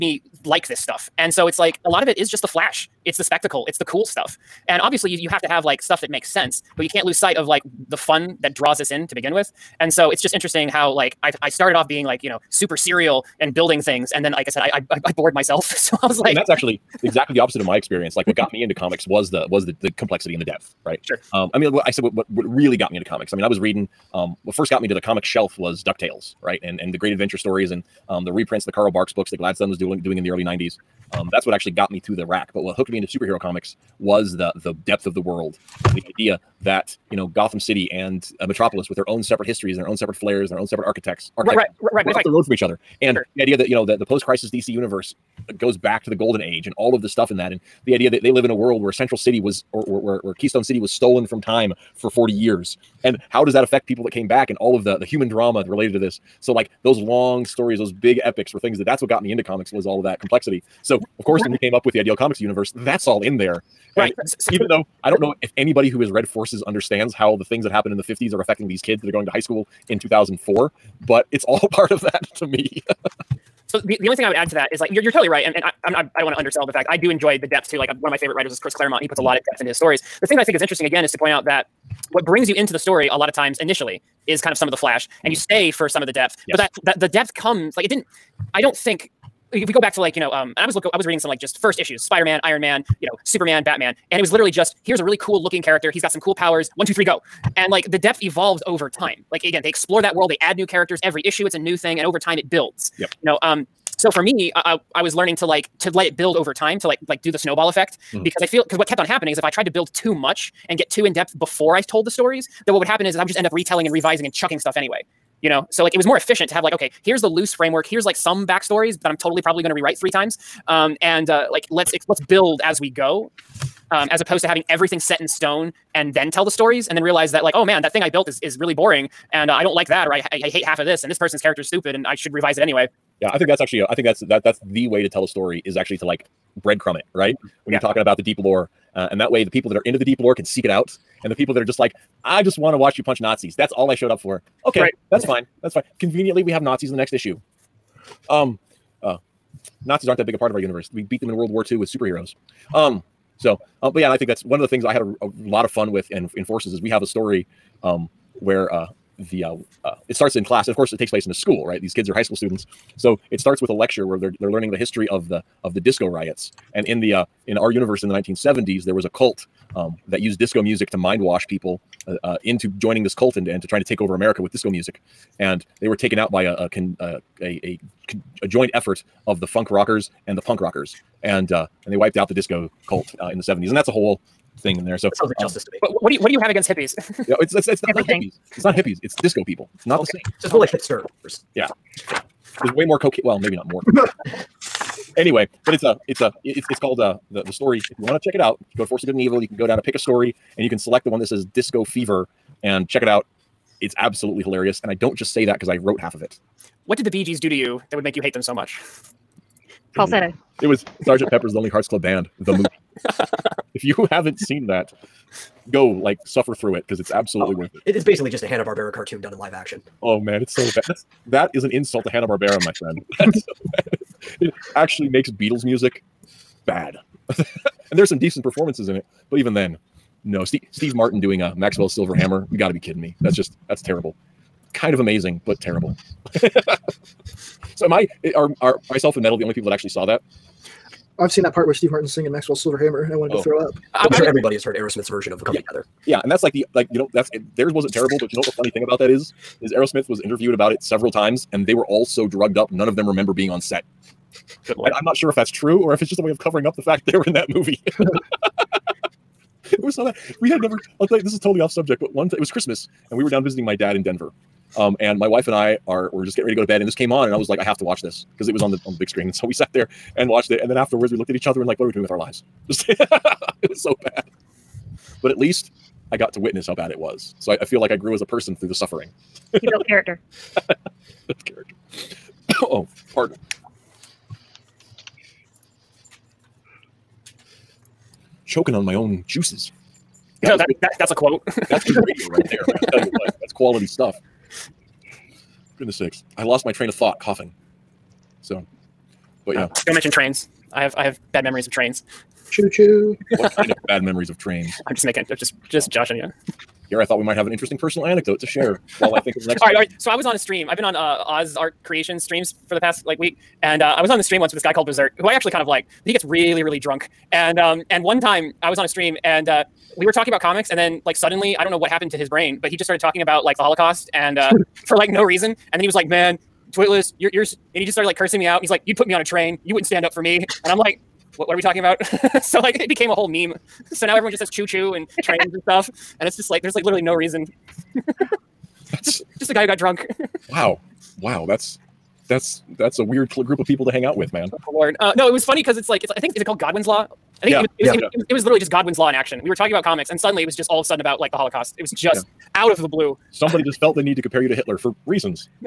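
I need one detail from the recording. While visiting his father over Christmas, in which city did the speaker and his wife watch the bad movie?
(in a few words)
Denver.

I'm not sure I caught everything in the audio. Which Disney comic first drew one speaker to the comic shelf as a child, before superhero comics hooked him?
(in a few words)
DuckTales.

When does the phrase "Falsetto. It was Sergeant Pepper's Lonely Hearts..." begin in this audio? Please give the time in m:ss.
3:29.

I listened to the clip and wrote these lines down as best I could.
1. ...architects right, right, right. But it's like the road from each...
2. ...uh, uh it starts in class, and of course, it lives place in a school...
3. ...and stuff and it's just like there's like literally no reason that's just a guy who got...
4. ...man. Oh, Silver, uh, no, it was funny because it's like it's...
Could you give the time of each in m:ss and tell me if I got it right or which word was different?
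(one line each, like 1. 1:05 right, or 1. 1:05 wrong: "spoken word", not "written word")
1. 0:41 right
2. 2:39 wrong: "takes", not "lives"
3. 5:35 right
4. 5:44 wrong: "Lord", not "Silver".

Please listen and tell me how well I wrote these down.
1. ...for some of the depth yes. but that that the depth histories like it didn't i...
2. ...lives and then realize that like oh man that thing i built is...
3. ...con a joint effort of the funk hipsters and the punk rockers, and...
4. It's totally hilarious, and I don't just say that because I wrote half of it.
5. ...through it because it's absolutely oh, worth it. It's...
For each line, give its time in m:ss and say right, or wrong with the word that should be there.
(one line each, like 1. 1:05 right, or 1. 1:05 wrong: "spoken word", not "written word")
1. 1:25 wrong: "comes", not "histories"
2. 2:06 wrong: "stories", not "lives"
3. 2:58 wrong: "rockers", not "hipsters"
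4. 3:23 wrong: "absolutely", not "totally"
5. 3:36 right.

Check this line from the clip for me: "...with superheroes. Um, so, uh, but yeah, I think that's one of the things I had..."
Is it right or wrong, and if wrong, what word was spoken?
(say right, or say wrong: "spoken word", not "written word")
right.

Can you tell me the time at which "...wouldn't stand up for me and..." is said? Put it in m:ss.
5:29.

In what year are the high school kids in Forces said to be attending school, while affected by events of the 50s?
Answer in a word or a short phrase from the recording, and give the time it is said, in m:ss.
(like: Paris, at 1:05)
2004, at 1:09.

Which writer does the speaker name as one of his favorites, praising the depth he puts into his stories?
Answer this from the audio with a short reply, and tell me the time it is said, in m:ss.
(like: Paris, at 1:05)
Chris Claremont, at 1:18.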